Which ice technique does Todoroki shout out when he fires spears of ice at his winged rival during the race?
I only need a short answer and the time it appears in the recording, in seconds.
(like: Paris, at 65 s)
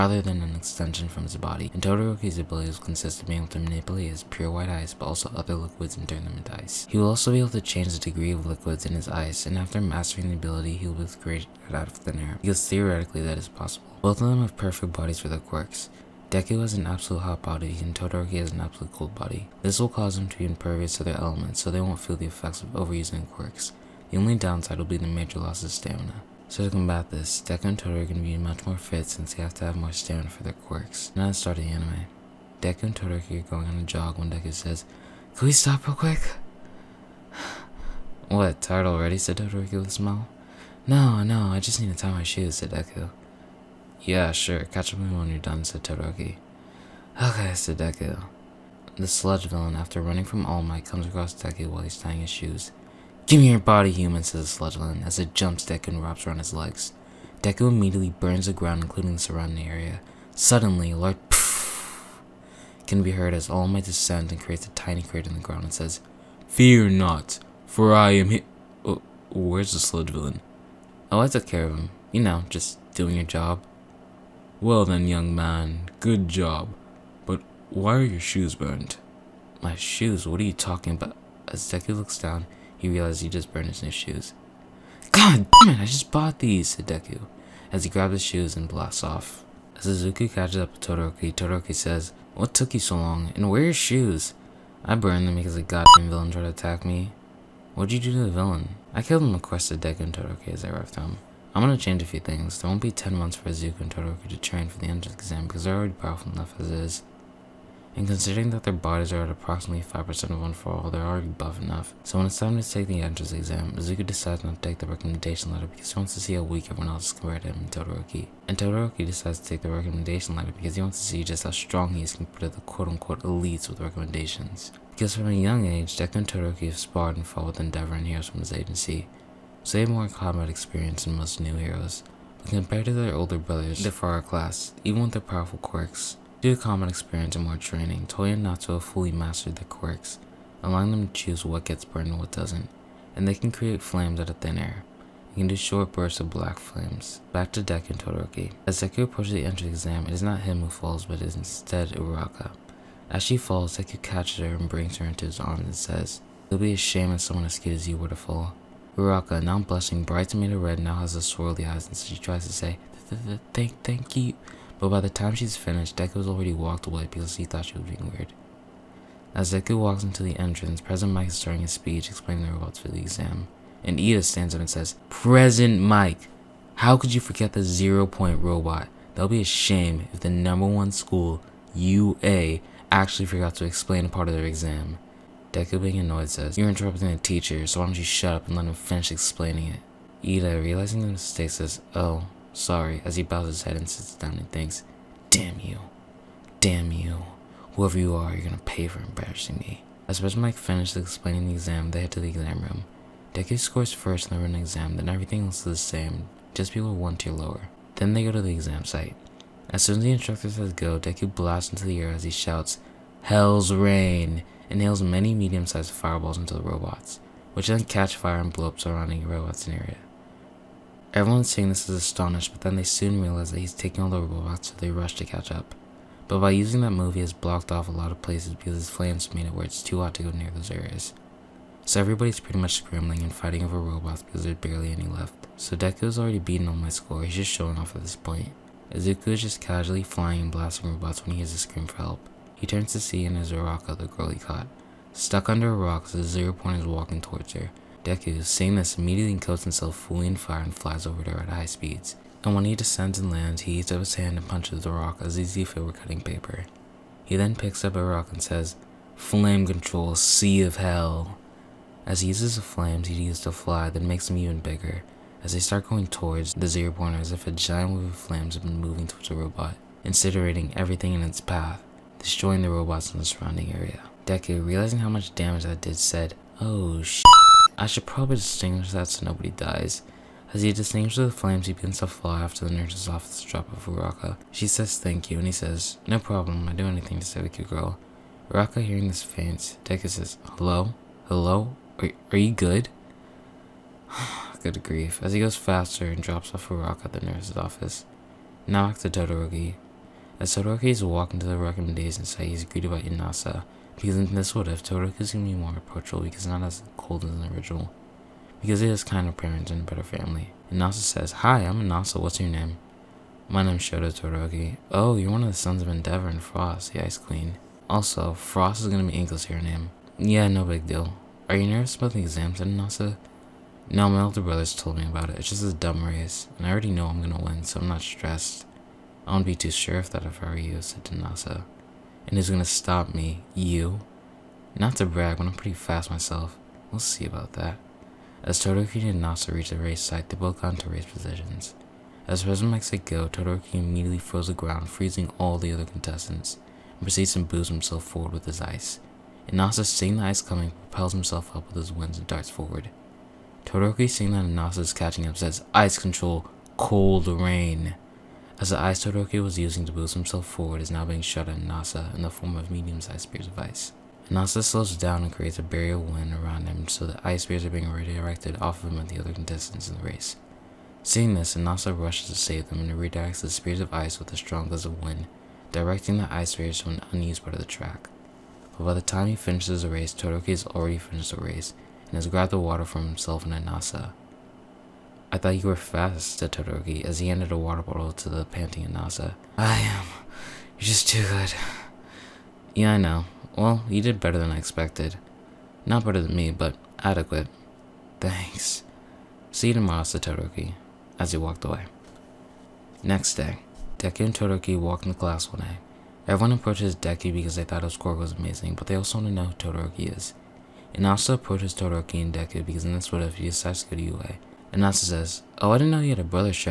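Cold rain, at 356 s.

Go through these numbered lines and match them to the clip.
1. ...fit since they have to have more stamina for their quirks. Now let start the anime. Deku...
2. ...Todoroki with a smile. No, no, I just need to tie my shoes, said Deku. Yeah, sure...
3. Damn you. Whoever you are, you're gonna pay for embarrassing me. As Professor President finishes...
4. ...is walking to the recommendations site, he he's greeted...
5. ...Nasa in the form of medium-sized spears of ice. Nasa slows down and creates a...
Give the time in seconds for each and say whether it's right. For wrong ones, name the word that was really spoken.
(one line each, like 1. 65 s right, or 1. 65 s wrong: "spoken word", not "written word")
1. 28 s right
2. 39 s right
3. 196 s wrong: "Mike", not "President"
4. 300 s right
5. 361 s right.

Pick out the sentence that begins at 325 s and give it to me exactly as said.
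It's just a dumb race, and I already know I'm going to win, so I'm not stressed.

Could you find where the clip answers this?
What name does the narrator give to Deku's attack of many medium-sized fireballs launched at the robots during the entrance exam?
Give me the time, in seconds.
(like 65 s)
213 s.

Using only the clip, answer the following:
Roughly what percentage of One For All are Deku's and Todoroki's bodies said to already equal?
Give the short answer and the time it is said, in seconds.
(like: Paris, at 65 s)
5%, at 109 s.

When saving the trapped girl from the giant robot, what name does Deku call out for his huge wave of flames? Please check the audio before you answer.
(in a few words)
Sea of hell.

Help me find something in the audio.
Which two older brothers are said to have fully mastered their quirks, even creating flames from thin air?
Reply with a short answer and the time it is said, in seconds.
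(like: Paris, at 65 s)
Toya and Natsu, at 138 s.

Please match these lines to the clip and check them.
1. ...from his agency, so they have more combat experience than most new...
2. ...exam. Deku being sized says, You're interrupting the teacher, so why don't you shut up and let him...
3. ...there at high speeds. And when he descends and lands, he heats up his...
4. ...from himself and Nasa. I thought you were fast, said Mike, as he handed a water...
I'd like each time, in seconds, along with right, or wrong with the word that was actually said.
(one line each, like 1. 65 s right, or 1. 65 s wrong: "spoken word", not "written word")
1. 128 s right
2. 184 s wrong: "annoyed", not "sized"
3. 251 s right
4. 382 s wrong: "Todoroki", not "Mike".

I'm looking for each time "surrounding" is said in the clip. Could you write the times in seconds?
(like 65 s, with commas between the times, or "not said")
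59 s, 218 s, 273 s.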